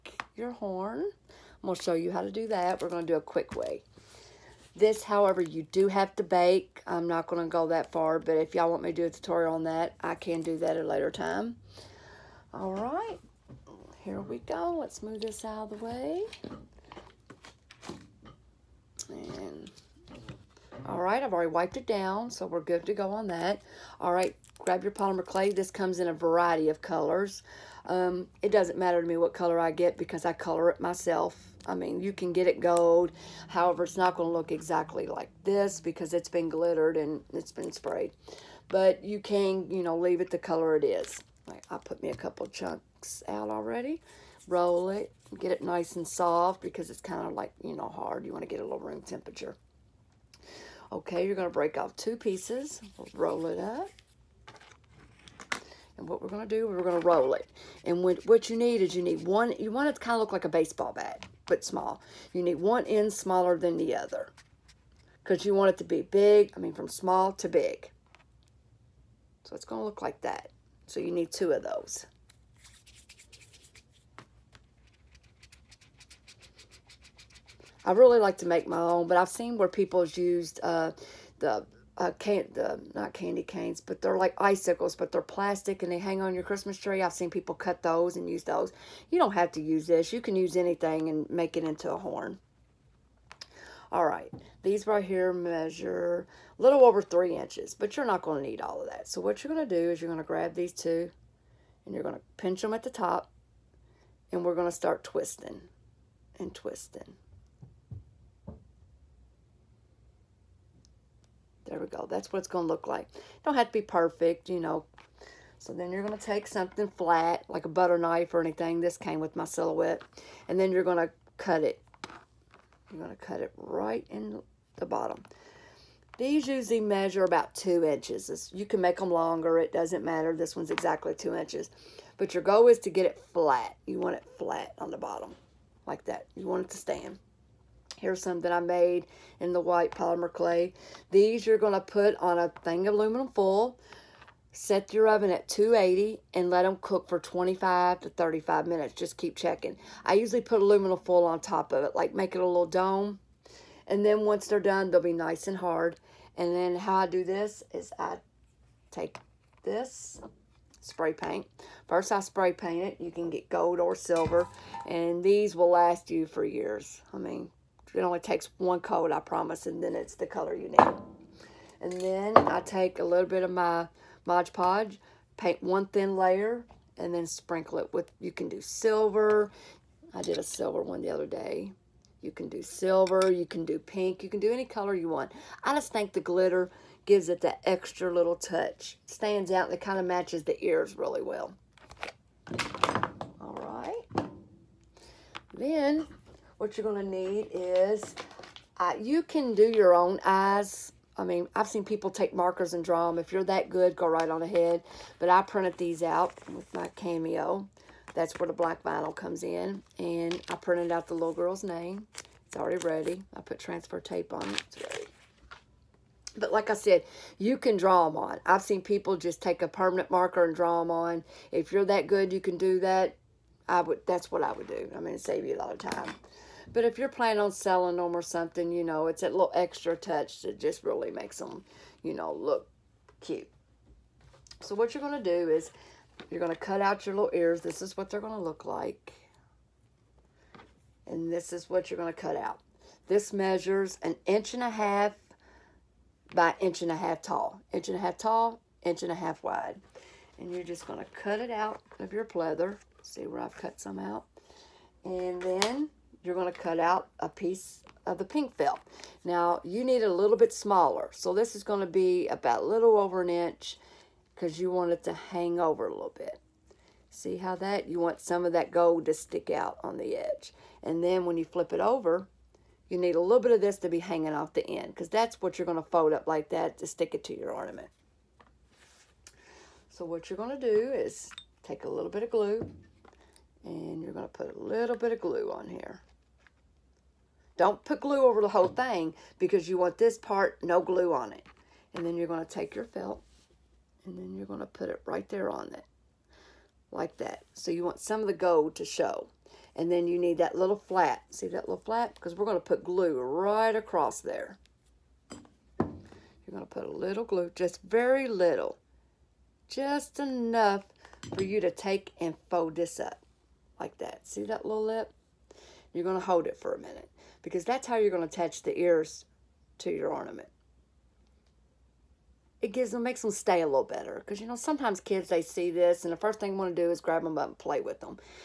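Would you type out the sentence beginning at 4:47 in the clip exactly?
Don't put glue over the whole thing because you want this part, no glue on it.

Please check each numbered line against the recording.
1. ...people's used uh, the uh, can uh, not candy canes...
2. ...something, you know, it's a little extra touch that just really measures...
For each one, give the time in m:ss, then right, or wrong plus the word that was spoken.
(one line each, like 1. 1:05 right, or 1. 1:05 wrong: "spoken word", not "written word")
1. 1:19 right
2. 3:48 wrong: "makes", not "measures".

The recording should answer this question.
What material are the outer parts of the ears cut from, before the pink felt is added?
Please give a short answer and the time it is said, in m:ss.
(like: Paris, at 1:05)
Pleather, at 4:12.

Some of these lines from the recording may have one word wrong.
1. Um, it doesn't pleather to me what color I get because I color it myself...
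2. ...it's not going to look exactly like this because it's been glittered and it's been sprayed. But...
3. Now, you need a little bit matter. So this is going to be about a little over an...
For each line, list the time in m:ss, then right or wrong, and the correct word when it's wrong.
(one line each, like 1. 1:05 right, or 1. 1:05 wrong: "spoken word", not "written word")
1. 0:27 wrong: "matter", not "pleather"
2. 0:33 right
3. 4:19 wrong: "smaller", not "matter".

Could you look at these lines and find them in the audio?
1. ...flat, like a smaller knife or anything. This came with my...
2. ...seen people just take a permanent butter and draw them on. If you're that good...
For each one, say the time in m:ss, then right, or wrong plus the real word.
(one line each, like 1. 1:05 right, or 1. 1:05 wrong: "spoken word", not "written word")
1. 1:56 wrong: "butter", not "smaller"
2. 3:38 wrong: "marker", not "butter".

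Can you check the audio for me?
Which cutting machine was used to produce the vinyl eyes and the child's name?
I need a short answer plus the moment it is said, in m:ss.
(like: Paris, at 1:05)
Cameo, at 3:26.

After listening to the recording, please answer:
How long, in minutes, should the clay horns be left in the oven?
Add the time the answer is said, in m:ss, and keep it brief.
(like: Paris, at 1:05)
25 to 35 minutes, at 2:27.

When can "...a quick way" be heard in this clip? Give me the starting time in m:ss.
0:03.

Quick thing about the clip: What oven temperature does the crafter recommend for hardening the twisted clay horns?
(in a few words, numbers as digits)
280.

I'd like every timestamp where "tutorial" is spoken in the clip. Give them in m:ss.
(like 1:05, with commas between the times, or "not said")
0:09.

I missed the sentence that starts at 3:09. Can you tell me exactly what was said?
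stands out and it kind of matches the ears really well.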